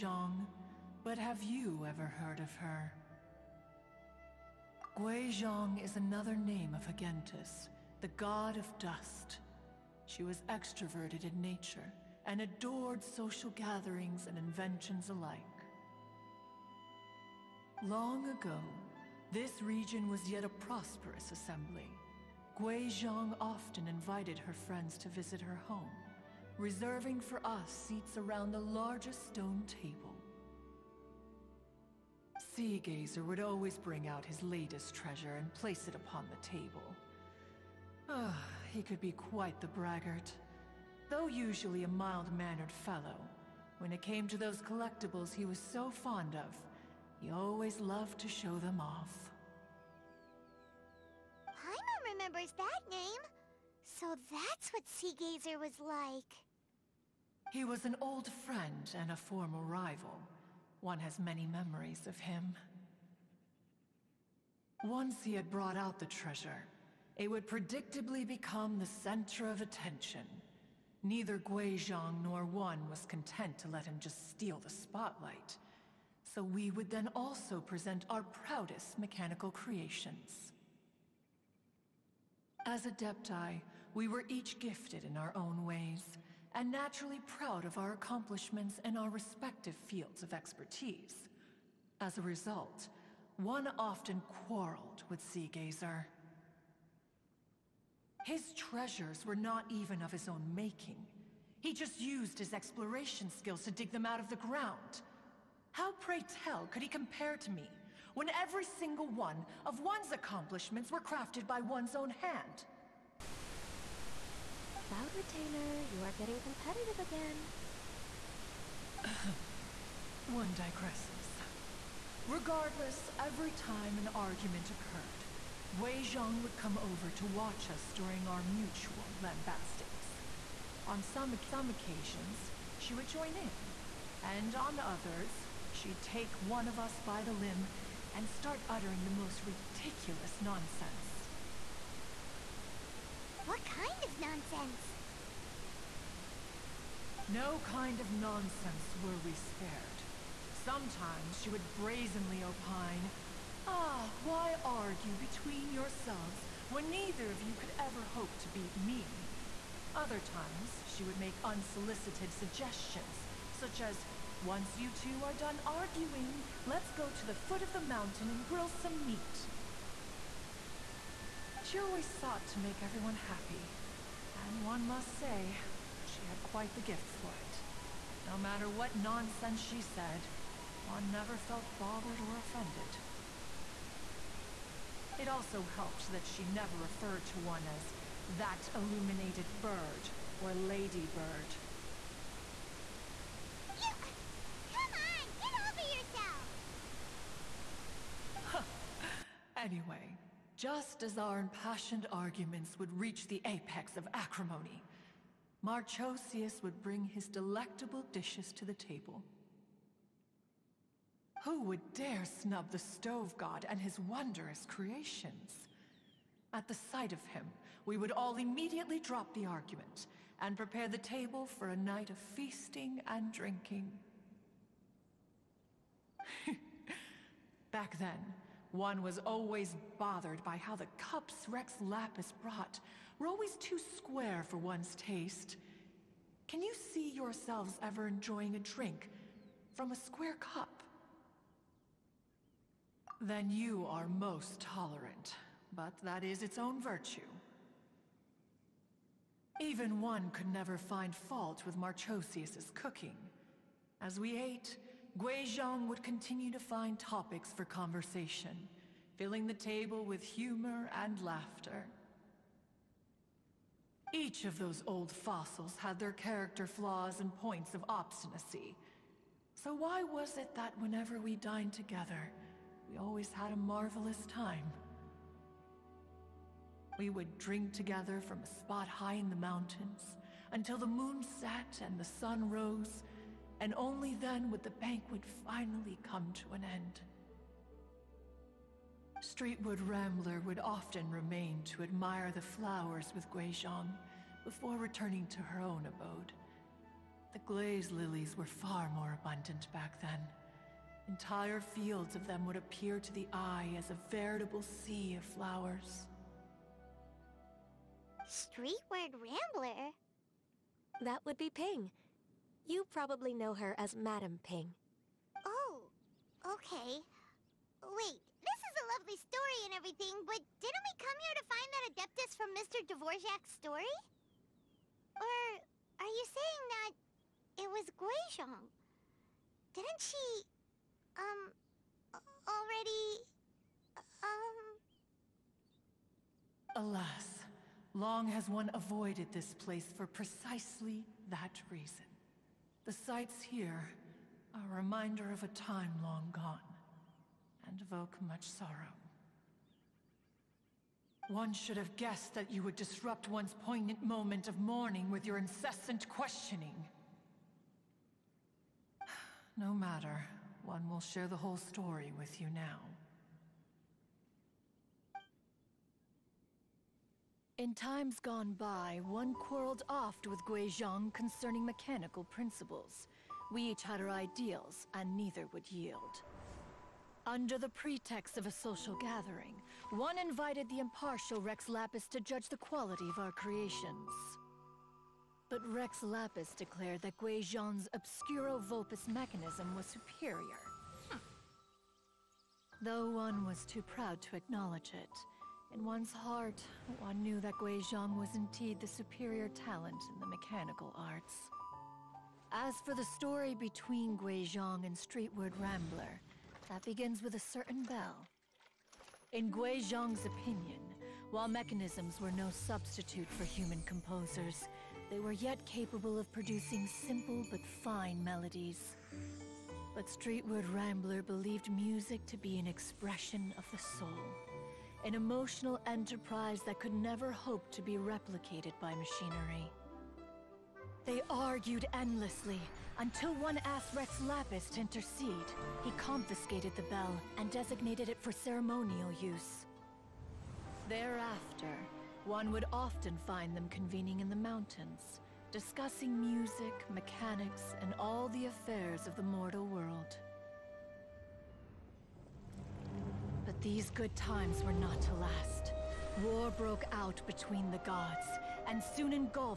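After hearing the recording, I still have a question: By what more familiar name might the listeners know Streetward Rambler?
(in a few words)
Madam Ping.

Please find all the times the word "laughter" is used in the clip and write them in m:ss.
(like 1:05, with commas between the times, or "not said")
4:21.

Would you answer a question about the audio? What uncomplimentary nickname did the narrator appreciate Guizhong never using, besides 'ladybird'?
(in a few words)
Illuminated bird.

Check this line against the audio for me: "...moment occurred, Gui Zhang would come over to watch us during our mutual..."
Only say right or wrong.
wrong.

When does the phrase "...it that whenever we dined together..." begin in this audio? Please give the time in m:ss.
4:30.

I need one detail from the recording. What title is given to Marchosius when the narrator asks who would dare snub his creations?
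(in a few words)
Stove god.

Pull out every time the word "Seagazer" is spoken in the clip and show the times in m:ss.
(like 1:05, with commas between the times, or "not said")
0:54, 1:35.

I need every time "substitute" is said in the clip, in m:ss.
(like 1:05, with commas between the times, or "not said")
6:52.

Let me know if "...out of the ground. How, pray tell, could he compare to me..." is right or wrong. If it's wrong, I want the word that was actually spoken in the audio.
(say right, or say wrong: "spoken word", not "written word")
right.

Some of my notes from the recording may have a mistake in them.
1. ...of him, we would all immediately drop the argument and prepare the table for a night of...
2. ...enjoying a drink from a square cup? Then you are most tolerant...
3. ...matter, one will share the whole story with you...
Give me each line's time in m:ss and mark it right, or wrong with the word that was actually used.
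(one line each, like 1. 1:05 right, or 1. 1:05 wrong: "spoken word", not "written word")
1. 3:37 right
2. 3:58 right
3. 5:59 right.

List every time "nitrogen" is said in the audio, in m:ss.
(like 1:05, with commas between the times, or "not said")
not said.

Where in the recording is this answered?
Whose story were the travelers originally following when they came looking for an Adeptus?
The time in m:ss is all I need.
5:22.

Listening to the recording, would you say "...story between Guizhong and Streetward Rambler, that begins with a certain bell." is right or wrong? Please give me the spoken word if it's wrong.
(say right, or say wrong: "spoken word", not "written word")
right.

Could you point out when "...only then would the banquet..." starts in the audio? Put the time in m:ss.
4:43.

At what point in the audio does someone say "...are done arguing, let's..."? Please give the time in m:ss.
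2:45.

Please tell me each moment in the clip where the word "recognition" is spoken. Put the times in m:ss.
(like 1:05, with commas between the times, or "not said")
not said.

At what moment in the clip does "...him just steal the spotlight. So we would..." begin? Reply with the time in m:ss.
1:13.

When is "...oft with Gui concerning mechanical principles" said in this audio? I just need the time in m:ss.
6:09.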